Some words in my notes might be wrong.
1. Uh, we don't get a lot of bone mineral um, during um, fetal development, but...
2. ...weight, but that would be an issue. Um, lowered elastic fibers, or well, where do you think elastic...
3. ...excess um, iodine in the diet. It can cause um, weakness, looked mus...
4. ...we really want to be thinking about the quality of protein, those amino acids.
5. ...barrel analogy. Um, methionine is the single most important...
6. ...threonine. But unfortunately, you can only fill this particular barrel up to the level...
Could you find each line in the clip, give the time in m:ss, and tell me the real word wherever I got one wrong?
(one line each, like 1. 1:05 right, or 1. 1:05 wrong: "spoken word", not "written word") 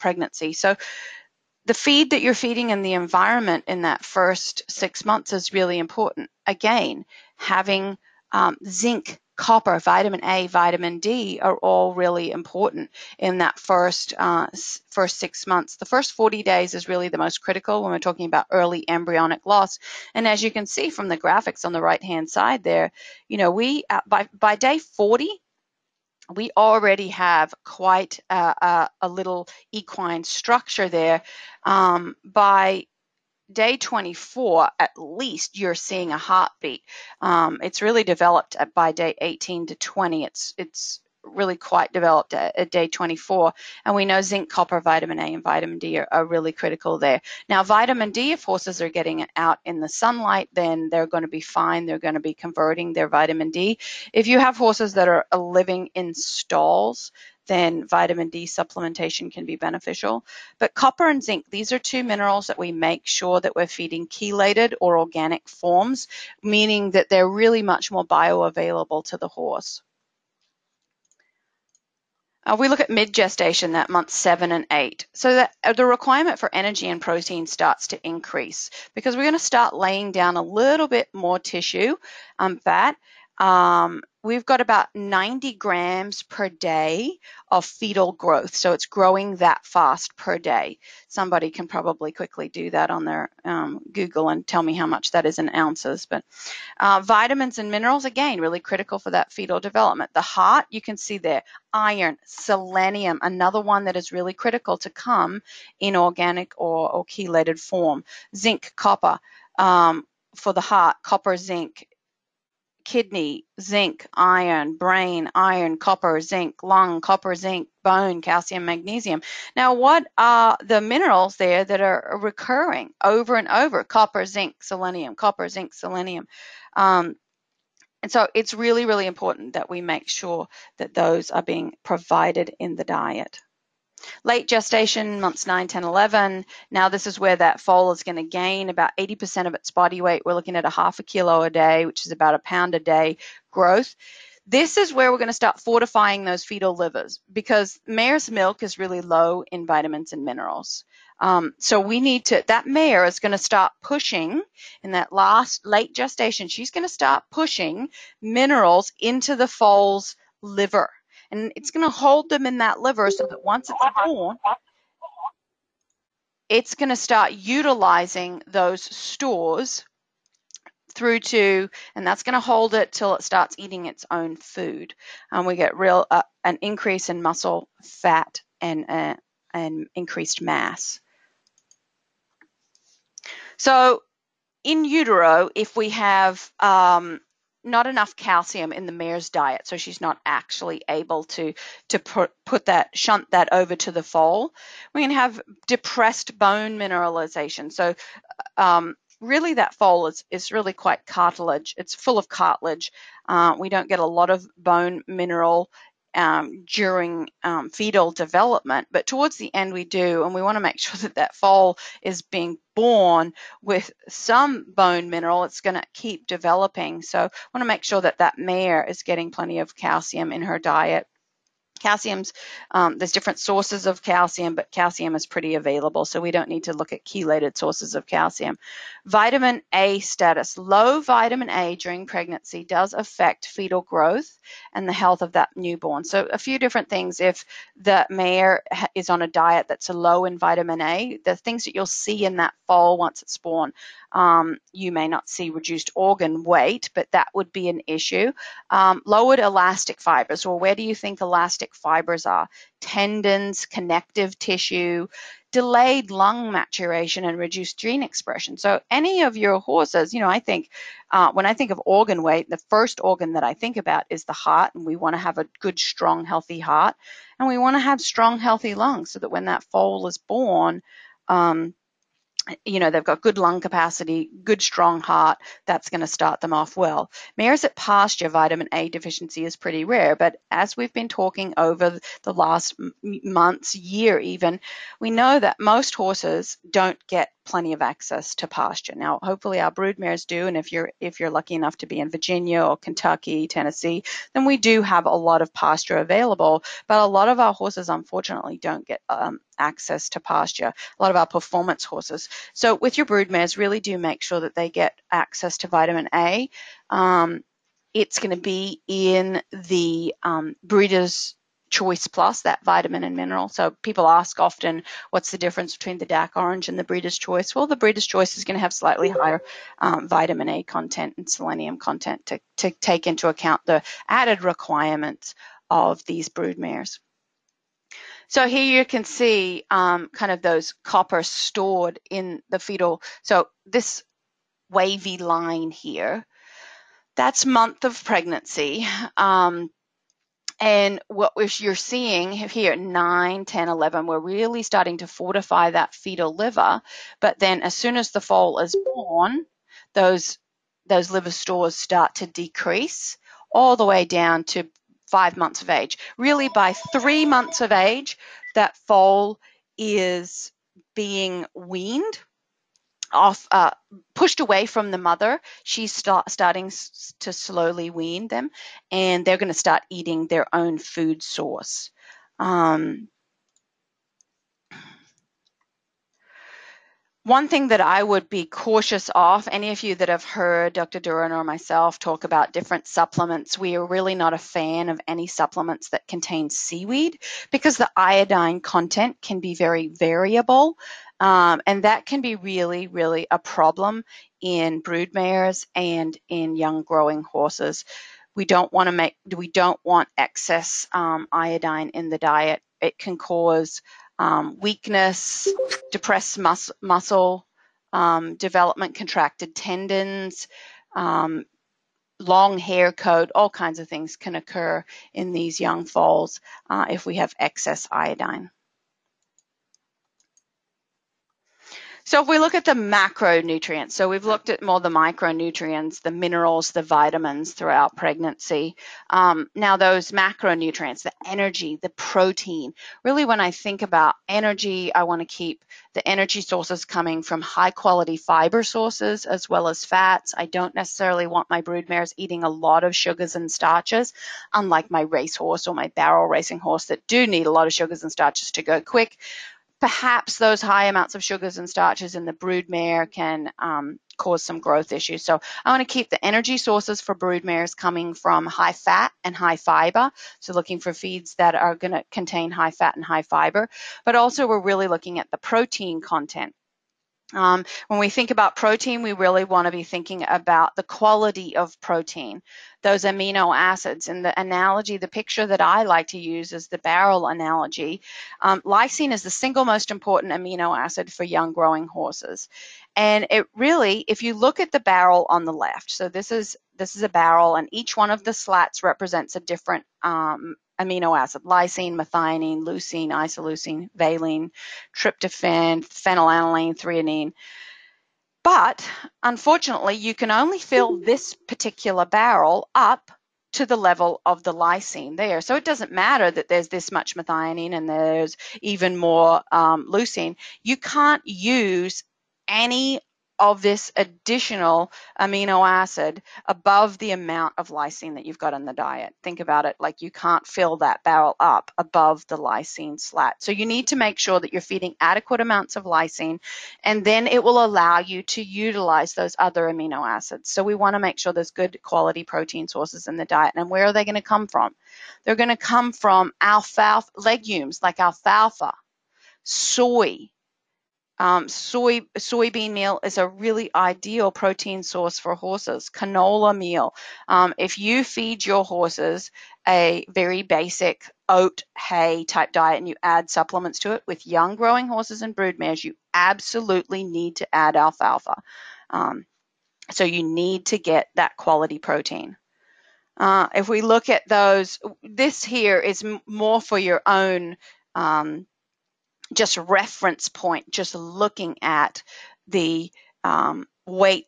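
1. 3:23 right
2. 4:06 right
3. 6:40 wrong: "depressed", not "looked"
4. 7:49 right
5. 7:56 wrong: "lysine", not "methionine"
6. 8:16 right.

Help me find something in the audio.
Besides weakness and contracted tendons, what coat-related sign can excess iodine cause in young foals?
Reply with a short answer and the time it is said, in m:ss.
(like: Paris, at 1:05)
Long hair coat, at 6:52.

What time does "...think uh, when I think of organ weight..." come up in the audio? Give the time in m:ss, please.
4:20.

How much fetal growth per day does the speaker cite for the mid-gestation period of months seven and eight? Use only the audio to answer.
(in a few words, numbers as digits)
90 grams.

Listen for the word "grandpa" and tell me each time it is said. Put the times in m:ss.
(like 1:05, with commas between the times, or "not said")
not said.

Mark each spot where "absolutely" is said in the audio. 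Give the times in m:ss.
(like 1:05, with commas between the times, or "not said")
9:16.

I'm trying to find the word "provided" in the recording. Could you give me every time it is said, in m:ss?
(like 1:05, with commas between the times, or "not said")
2:11.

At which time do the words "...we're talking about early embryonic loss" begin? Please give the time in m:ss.
0:17.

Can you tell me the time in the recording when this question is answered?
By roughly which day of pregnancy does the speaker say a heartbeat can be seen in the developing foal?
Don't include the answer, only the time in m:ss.
0:32.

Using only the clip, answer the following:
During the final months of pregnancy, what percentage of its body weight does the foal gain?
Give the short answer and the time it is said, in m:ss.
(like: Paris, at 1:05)
80%, at 2:18.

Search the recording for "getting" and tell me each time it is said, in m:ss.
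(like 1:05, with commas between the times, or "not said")
0:48, 3:39.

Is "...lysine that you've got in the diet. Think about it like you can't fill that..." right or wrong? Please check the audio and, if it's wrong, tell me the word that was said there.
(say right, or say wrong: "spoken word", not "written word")
right.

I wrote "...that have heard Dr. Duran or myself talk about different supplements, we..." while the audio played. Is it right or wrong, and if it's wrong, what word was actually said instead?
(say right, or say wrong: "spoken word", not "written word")
right.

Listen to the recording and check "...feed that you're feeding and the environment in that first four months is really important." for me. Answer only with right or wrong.
wrong.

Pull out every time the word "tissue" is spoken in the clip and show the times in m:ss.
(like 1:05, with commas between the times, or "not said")
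1:21, 4:14.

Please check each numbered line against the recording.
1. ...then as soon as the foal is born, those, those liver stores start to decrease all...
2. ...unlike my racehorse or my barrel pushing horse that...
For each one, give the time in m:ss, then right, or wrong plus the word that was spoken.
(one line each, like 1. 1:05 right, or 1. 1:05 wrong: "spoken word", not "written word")
1. 5:47 right
2. 7:24 wrong: "racing", not "pushing".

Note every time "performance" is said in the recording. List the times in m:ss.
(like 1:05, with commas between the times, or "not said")
5:01.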